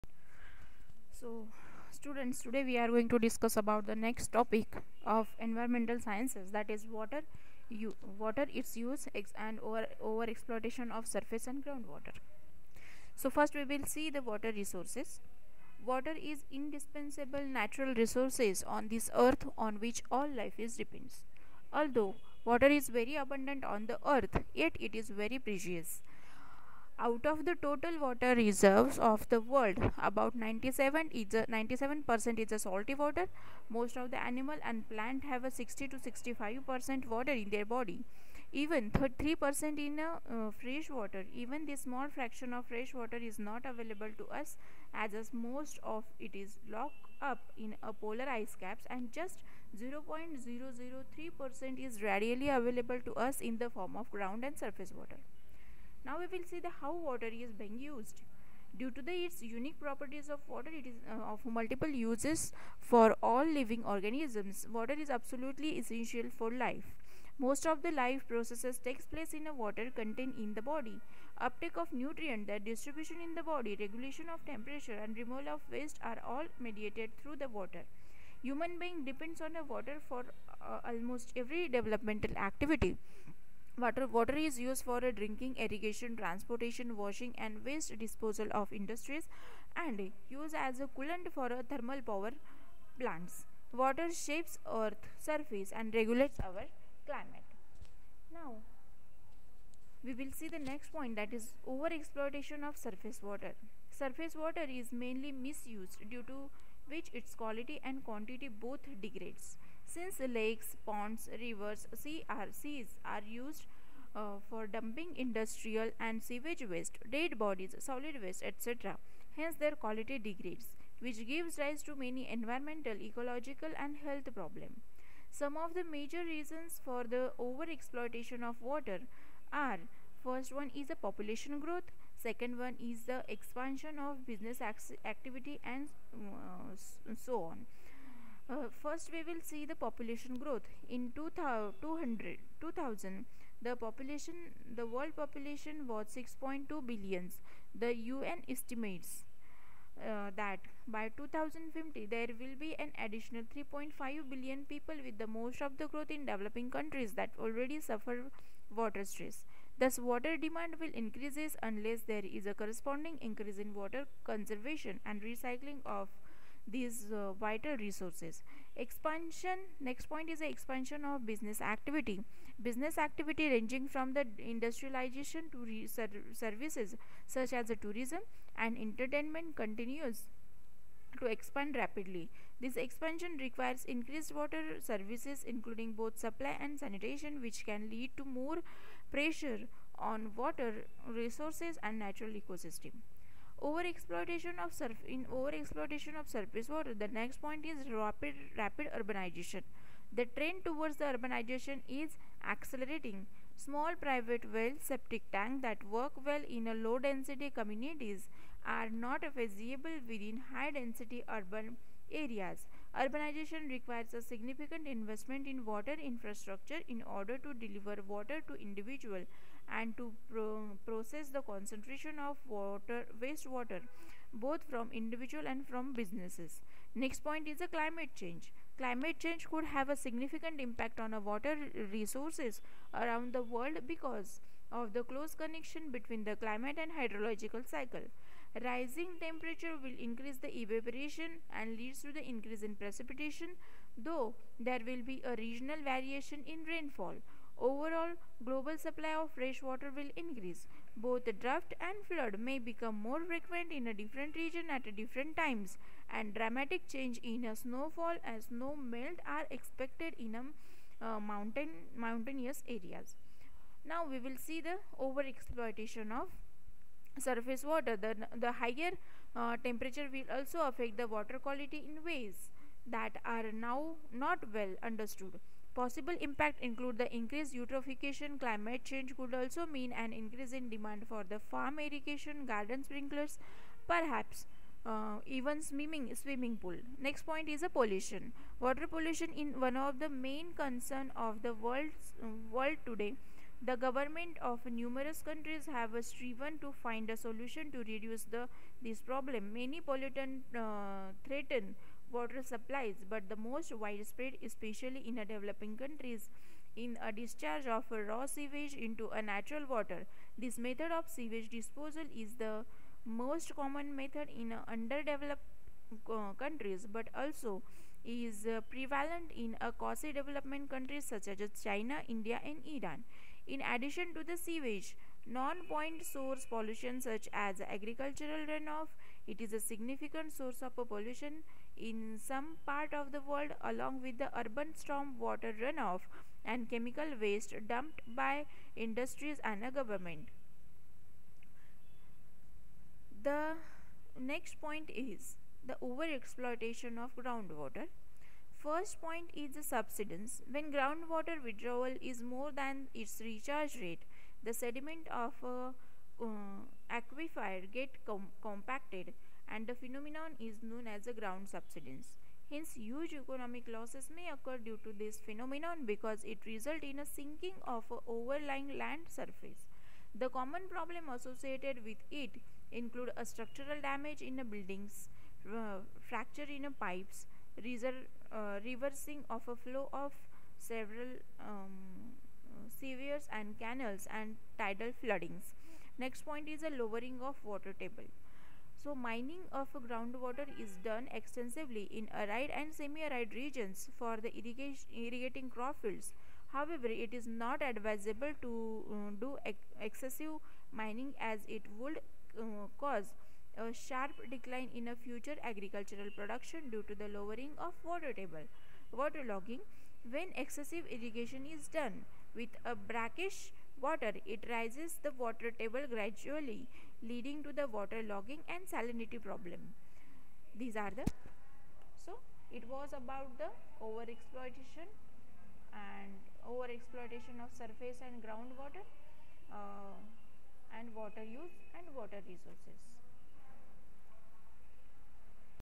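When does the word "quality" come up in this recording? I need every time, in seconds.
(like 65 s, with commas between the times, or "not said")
107 s, 119 s, 271 s.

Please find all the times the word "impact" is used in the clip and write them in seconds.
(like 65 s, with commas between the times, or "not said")
230 s, 276 s.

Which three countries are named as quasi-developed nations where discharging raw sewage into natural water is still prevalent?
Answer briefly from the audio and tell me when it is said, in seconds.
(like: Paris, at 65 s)
China, India, and Iran, at 321 s.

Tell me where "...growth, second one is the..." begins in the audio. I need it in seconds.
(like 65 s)
131 s.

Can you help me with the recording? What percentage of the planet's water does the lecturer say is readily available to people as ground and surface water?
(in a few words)
0.003 percent.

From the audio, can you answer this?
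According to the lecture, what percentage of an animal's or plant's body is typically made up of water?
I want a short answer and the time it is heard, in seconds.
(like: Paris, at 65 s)
60 to 65 percent, at 35 s.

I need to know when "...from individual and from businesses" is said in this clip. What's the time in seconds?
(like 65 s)
224 s.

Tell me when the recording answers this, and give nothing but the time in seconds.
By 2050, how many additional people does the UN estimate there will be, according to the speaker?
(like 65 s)
153 s.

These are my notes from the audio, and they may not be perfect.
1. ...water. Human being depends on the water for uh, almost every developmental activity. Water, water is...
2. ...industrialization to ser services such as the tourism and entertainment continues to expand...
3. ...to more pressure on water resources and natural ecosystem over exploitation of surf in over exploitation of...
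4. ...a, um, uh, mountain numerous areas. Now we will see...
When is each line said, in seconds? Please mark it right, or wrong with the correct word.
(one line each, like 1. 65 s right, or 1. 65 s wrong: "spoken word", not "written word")
1. 77 s right
2. 174 s right
3. 188 s right
4. 260 s wrong: "mountainous", not "numerous".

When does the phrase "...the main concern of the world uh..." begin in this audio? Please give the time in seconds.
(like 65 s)
289 s.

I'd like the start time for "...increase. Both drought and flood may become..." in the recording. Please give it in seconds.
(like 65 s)
250 s.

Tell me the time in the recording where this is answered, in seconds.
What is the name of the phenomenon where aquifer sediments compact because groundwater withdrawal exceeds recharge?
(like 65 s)
361 s.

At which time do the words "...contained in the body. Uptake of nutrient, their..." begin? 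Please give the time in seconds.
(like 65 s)
69 s.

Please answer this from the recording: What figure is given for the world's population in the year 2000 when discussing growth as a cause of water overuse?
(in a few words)
6.2 billion.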